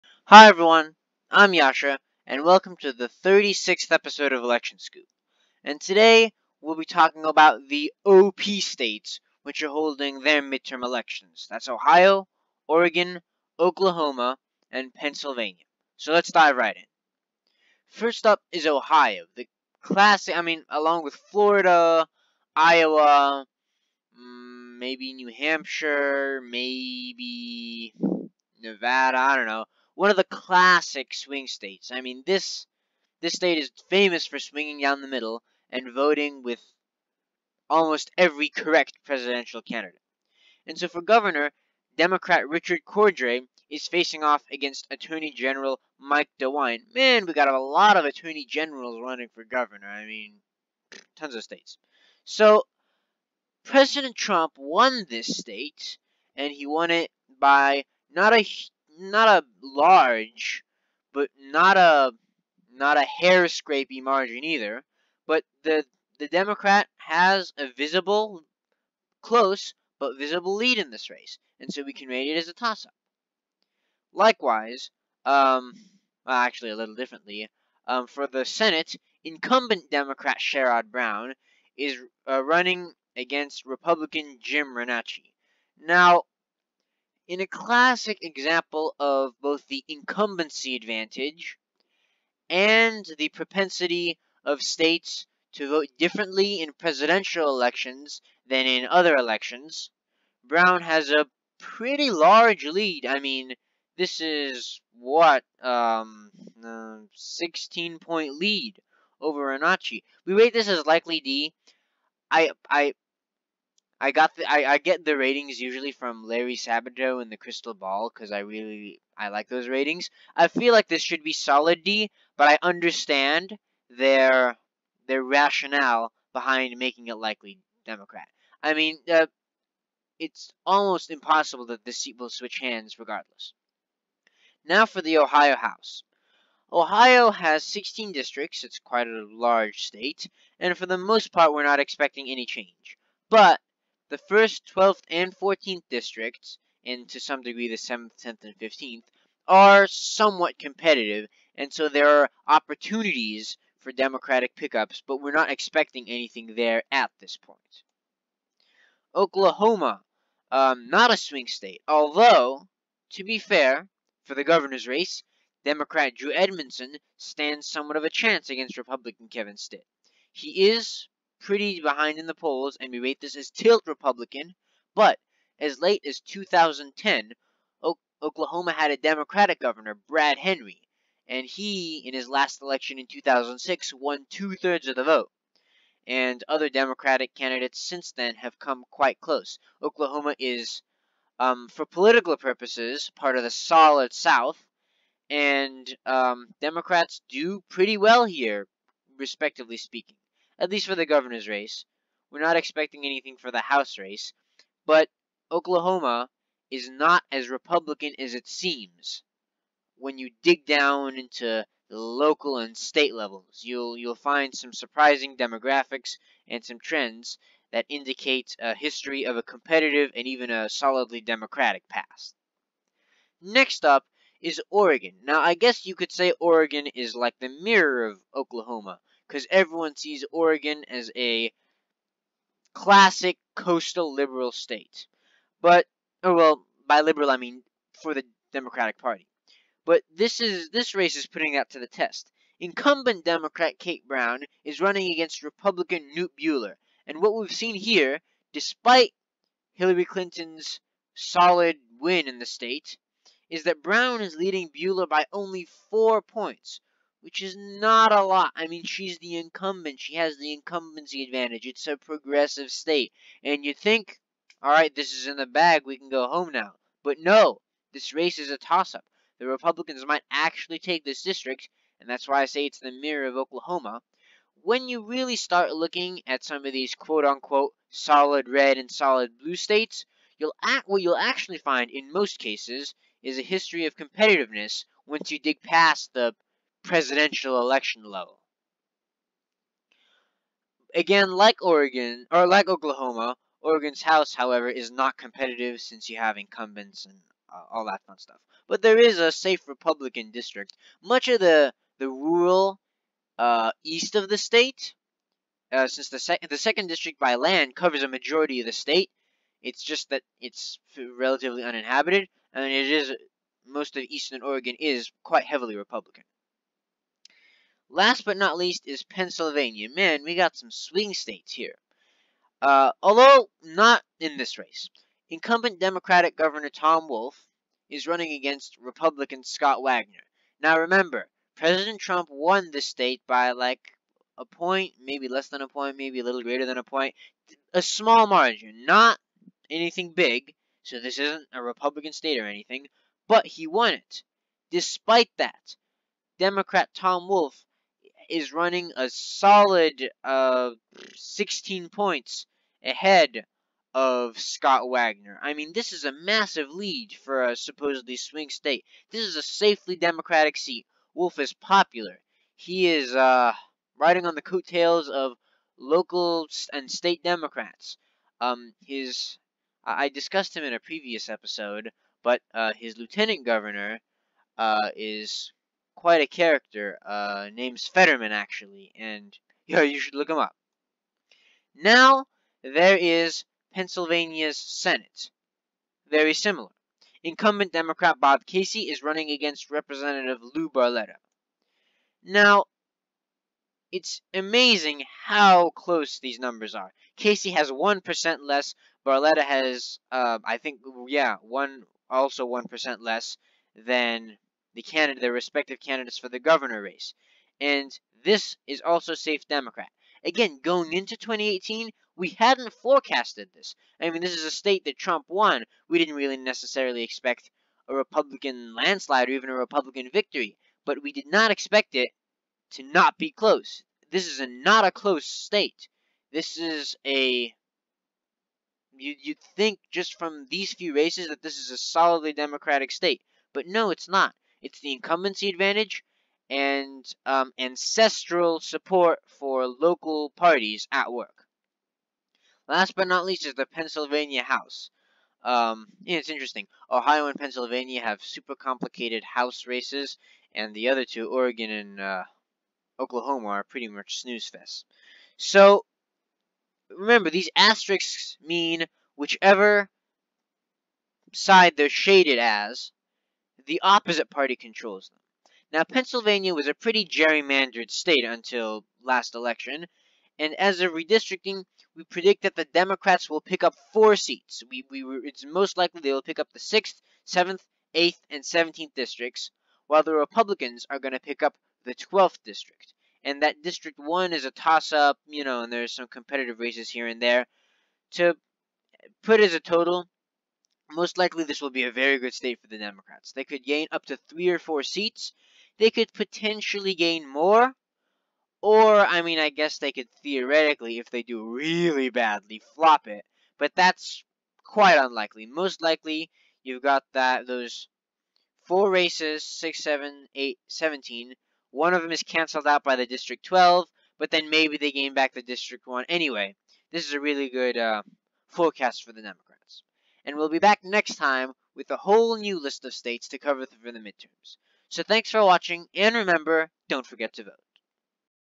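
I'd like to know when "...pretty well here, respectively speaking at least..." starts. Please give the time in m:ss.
3:17.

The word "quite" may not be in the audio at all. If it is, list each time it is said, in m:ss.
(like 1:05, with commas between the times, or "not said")
2:18, 3:08, 5:15, 6:15, 8:24.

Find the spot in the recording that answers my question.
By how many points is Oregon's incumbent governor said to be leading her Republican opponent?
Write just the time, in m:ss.
4:15.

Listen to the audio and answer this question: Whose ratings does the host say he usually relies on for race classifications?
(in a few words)
Larry Sabato.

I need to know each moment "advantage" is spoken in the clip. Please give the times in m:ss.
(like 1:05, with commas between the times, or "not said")
1:30, 4:21, 7:15.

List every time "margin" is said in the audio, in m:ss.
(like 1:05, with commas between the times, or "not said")
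1:04, 5:38.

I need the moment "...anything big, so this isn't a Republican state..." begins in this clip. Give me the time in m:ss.
5:39.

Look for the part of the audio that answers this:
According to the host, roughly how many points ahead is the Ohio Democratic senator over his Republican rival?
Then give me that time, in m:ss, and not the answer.
1:47.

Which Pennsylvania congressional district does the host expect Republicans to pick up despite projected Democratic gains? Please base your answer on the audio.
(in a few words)
12th.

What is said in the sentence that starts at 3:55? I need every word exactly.
But, or oh, well, by liberal I mean for the Democratic Party.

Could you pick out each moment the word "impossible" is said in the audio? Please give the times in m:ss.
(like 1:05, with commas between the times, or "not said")
2:11.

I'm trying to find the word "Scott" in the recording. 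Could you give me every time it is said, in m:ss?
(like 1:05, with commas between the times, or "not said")
5:29, 5:54.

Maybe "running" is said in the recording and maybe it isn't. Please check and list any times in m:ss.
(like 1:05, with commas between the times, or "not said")
0:49, 1:22, 4:04, 5:28, 5:48, 6:29.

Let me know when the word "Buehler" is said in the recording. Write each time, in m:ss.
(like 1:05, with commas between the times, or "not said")
4:06, 4:14.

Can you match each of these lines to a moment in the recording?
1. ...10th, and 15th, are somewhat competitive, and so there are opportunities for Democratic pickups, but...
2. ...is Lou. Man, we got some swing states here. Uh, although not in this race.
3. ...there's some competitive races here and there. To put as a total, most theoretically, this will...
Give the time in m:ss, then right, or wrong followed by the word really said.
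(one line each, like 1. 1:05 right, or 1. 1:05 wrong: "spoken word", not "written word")
1. 2:28 right
2. 5:18 wrong: "Pennsylvania", not "Lou"
3. 8:05 wrong: "likely", not "theoretically".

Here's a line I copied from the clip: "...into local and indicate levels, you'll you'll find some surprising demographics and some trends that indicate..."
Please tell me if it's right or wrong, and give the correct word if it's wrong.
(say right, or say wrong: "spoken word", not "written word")
wrong: "state", not "indicate".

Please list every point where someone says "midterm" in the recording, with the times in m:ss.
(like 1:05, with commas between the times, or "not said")
0:10, 8:43.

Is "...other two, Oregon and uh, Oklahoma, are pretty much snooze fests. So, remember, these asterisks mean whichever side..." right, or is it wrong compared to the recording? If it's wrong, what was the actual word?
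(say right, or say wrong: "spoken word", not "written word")
right.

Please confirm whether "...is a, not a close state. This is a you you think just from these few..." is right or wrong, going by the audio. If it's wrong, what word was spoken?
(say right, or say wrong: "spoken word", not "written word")
right.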